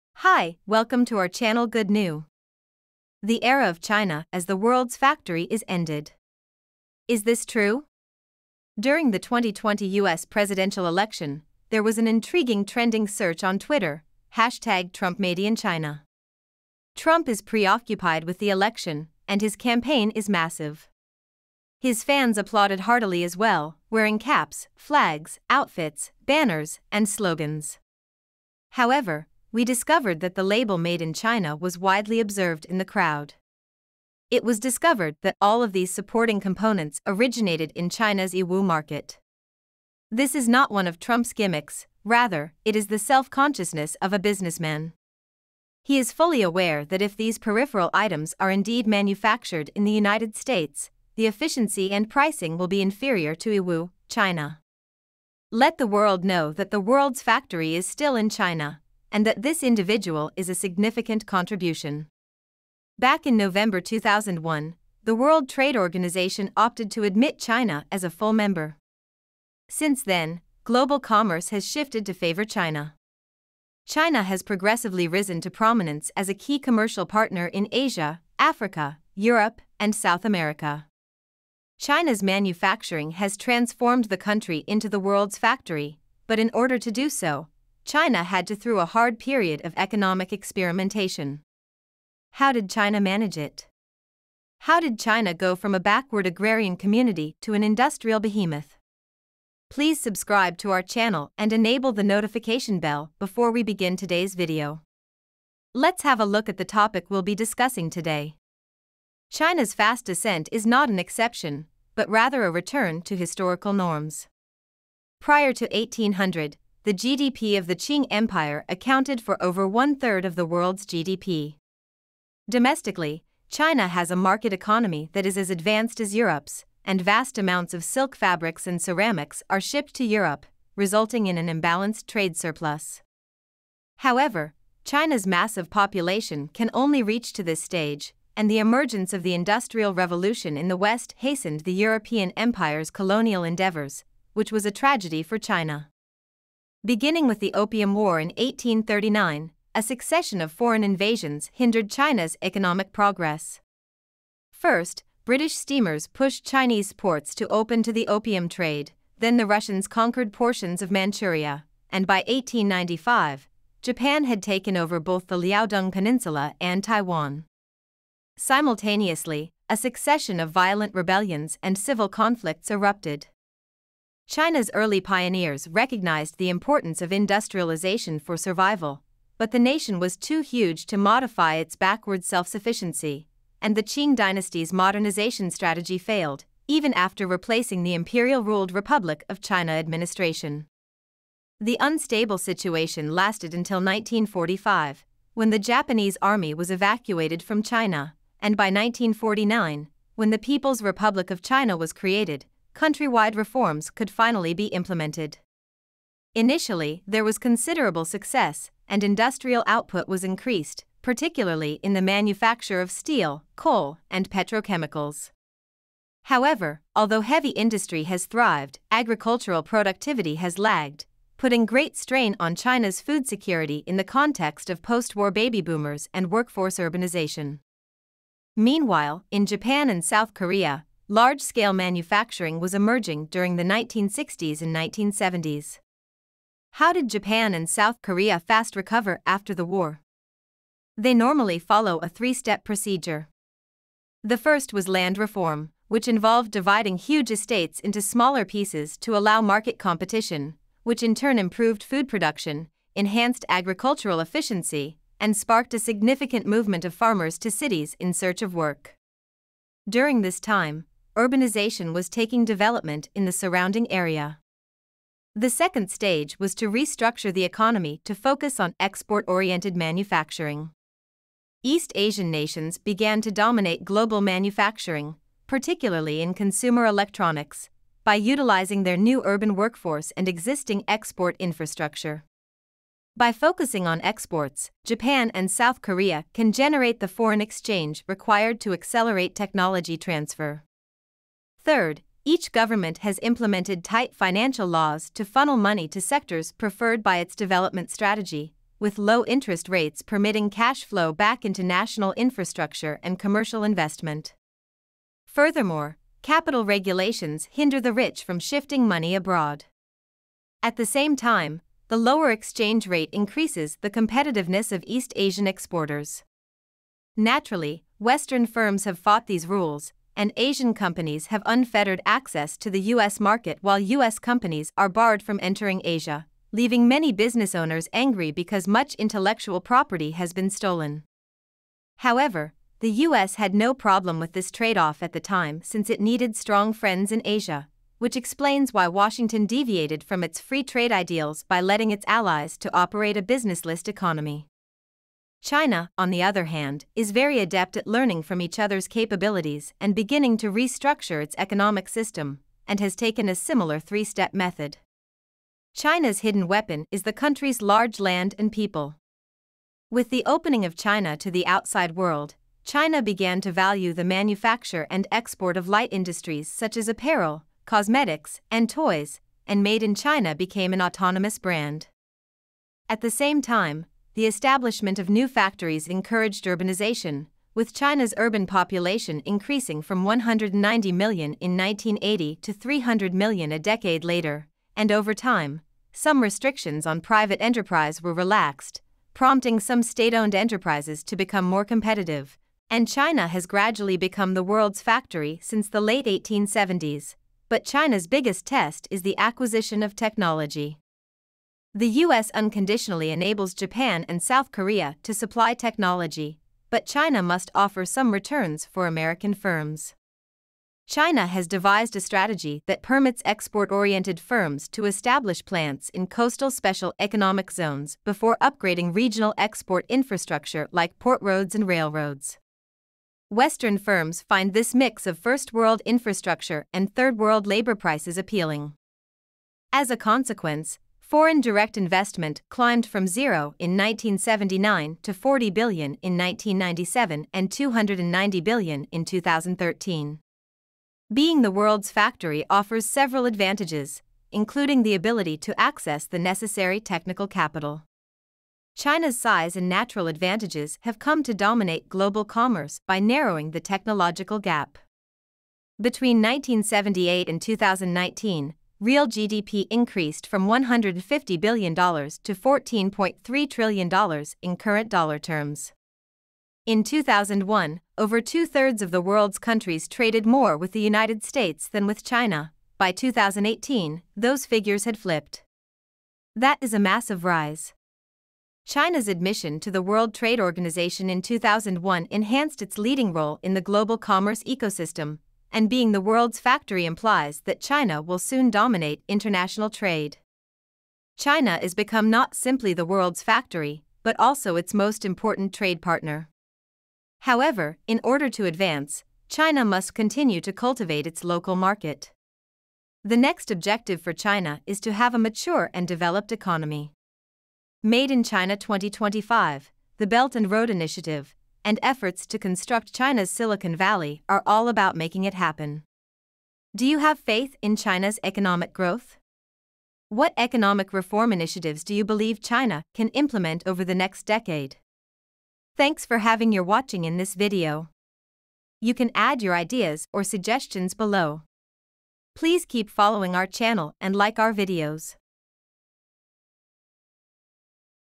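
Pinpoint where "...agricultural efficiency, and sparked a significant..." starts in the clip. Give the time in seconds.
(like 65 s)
253 s.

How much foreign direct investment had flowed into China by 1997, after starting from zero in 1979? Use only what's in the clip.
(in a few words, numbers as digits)
40 billion.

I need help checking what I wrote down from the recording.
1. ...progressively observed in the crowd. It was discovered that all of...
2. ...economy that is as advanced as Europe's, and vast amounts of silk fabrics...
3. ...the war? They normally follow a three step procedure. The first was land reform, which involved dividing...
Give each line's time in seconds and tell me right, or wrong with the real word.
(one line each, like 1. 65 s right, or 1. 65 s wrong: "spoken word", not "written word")
1. 31 s wrong: "widely", not "progressively"
2. 124 s right
3. 239 s right.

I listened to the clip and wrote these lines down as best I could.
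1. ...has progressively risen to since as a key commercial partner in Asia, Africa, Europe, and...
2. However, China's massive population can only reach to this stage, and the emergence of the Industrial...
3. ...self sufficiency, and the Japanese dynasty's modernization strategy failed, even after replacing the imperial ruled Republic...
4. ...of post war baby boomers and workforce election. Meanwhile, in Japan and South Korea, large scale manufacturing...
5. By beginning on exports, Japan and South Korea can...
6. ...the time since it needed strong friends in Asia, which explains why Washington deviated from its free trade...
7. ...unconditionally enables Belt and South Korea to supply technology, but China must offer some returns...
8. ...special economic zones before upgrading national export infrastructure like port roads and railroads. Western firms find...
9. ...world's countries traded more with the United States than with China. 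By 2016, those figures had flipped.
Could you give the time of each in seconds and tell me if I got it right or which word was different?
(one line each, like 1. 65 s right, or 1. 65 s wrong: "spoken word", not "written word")
1. 74 s wrong: "prominence", not "since"
2. 133 s right
3. 182 s wrong: "Qing", not "Japanese"
4. 224 s wrong: "urbanization", not "election"
5. 283 s wrong: "focusing", not "beginning"
6. 335 s right
7. 402 s wrong: "Japan", not "Belt"
8. 416 s wrong: "regional", not "national"
9. 469 s wrong: "2018", not "2016".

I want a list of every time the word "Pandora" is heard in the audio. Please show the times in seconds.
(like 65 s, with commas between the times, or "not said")
not said.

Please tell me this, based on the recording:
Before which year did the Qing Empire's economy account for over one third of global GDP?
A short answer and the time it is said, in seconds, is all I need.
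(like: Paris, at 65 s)
1800, at 115 s.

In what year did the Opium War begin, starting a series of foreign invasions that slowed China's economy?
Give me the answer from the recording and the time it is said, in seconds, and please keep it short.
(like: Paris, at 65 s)
1839, at 148 s.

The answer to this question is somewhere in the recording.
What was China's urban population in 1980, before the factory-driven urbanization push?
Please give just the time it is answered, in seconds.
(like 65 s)
380 s.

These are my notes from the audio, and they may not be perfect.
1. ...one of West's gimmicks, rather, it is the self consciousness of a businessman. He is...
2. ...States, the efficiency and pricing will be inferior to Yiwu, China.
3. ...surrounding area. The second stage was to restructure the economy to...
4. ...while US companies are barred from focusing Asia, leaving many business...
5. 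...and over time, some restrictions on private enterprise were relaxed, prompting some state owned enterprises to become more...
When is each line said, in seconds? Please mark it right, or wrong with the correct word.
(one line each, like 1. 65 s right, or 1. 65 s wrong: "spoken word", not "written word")
1. 40 s wrong: "Trump", not "West"
2. 50 s right
3. 263 s right
4. 323 s wrong: "entering", not "focusing"
5. 384 s right.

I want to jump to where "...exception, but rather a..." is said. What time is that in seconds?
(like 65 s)
110 s.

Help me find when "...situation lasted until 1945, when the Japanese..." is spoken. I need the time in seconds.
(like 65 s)
192 s.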